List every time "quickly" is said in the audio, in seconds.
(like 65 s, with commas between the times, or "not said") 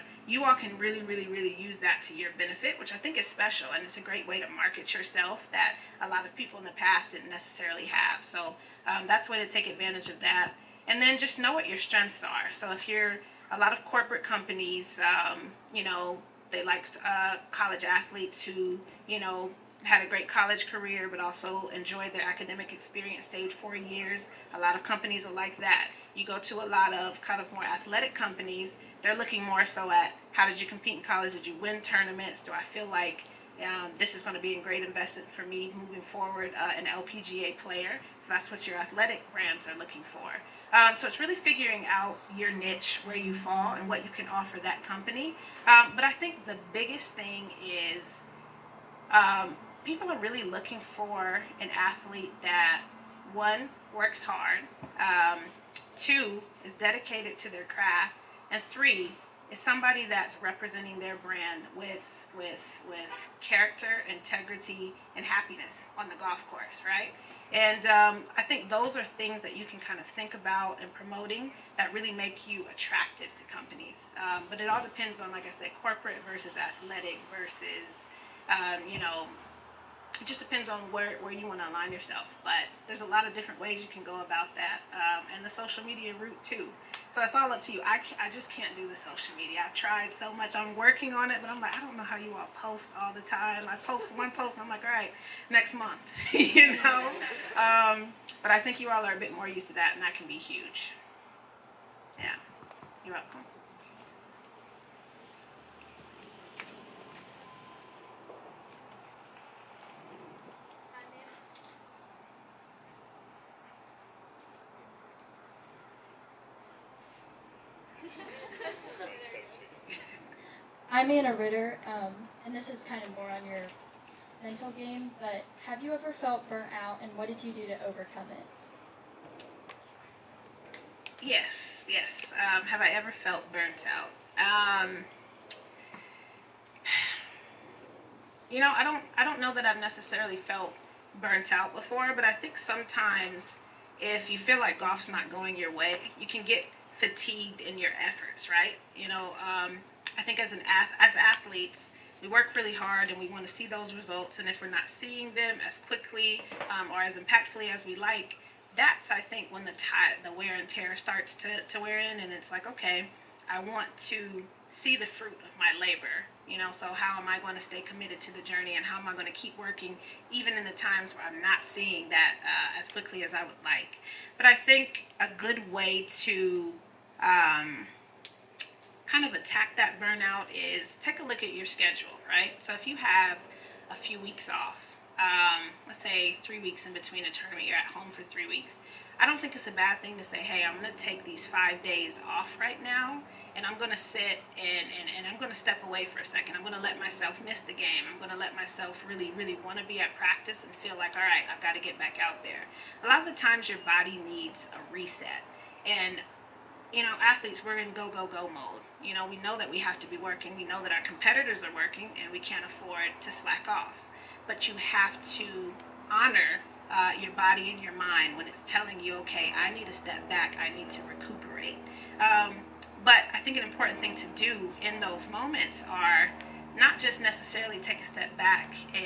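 155 s, 172 s.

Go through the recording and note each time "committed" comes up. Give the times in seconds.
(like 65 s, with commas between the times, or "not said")
167 s.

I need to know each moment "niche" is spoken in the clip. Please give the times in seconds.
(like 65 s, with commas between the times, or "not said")
42 s.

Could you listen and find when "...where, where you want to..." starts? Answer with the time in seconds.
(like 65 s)
80 s.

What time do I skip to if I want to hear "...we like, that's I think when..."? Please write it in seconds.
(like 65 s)
157 s.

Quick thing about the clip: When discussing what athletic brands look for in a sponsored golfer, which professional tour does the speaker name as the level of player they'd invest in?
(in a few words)
LPGA.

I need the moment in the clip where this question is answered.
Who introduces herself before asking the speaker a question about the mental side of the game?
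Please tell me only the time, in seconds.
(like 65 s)
121 s.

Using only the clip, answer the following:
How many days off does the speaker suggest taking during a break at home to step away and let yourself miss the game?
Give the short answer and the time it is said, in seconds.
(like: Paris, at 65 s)
5, at 191 s.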